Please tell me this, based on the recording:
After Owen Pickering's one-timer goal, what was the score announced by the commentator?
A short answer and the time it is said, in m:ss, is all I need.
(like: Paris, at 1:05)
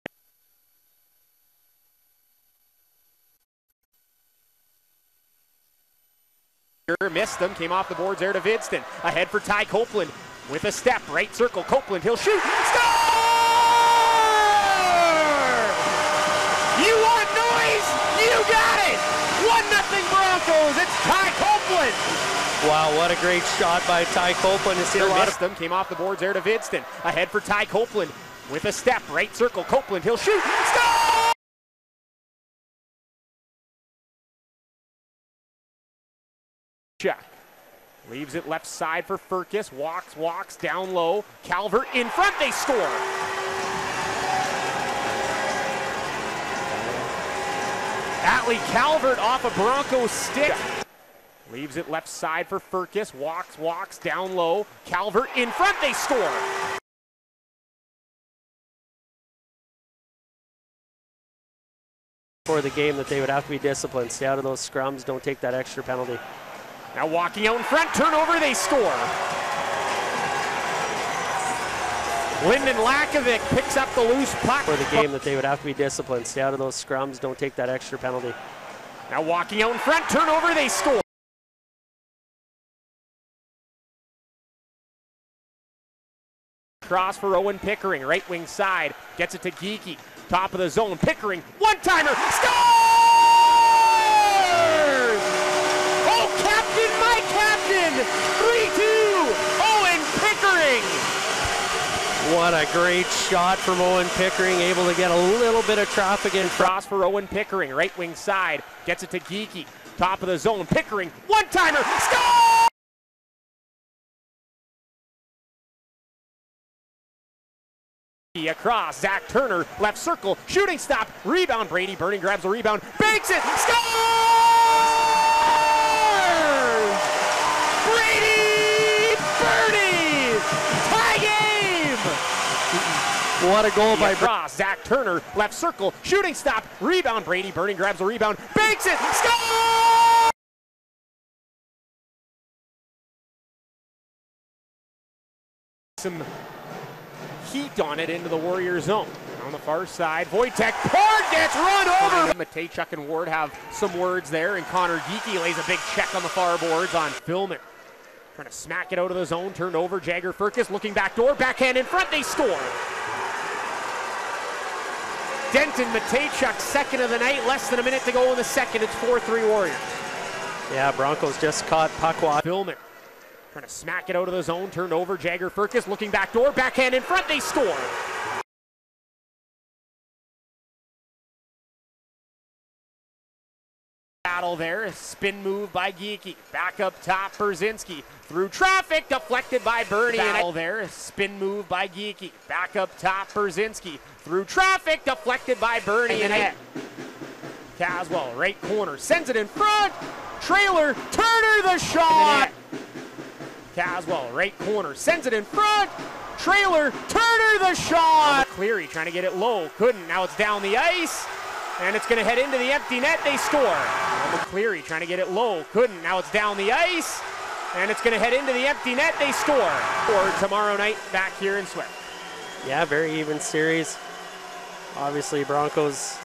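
3-2, at 1:38.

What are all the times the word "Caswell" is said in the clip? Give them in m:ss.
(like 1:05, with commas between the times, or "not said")
3:17, 3:23.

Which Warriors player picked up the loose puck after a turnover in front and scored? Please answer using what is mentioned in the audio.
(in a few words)
Lynden Lakovic.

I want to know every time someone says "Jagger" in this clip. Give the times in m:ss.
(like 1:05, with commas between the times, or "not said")
2:39, 2:55.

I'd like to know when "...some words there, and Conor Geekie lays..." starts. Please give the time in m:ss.
2:33.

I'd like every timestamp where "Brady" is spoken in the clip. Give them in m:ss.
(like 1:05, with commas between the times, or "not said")
2:01, 2:17.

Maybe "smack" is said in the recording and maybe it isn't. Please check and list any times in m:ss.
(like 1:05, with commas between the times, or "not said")
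2:38, 2:53.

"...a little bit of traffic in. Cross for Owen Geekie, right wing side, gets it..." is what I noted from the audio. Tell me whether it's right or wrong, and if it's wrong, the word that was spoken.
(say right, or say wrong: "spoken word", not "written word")
wrong: "Pickering", not "Geekie".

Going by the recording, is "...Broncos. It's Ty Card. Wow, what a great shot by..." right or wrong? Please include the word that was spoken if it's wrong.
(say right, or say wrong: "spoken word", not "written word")
wrong: "Copeland", not "Card".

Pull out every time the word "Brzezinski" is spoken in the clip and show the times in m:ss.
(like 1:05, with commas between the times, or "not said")
3:07, 3:13.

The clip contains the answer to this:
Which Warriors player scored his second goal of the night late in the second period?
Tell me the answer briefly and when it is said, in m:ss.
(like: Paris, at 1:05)
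Denton Mateychuk, at 2:45.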